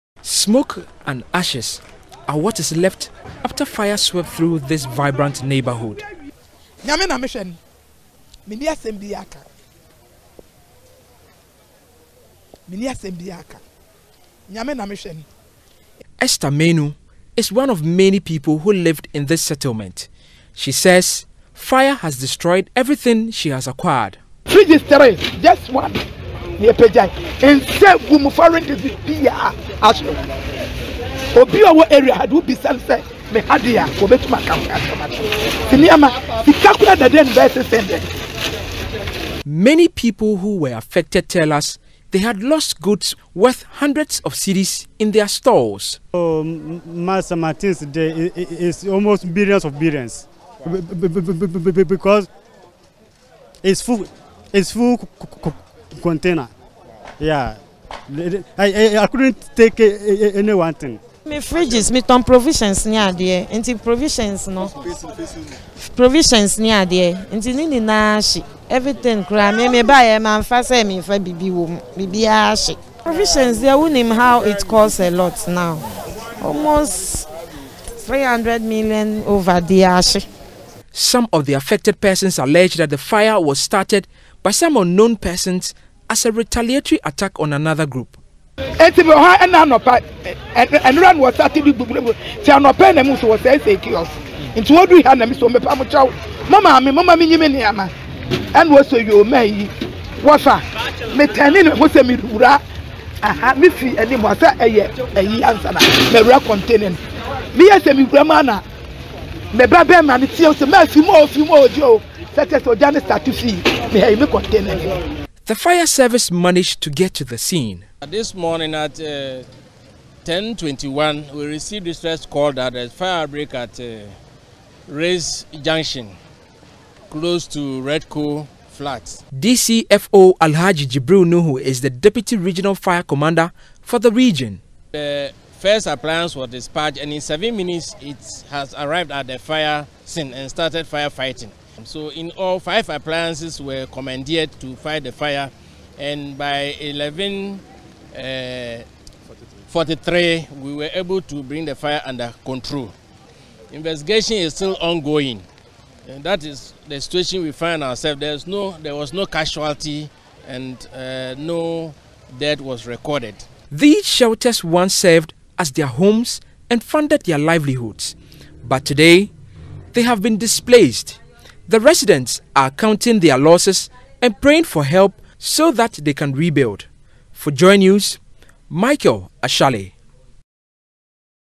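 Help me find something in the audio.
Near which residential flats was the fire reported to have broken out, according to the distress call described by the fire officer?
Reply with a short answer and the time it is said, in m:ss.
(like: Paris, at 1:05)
Redco Flats, at 2:07.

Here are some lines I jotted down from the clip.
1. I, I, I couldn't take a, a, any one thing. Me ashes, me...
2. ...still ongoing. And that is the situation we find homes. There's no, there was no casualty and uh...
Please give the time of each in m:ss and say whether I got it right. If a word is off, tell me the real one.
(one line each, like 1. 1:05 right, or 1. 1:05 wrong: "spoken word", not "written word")
1. 0:58 wrong: "fridges", not "ashes"
2. 2:34 wrong: "ourselves", not "homes".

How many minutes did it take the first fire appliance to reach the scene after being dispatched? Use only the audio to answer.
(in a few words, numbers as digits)
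7.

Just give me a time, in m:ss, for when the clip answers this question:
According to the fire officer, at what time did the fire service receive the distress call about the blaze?
2:00.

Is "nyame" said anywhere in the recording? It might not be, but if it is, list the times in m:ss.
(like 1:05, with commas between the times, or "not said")
0:06, 0:14.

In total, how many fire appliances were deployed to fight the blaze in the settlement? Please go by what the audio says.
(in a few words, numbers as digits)
5.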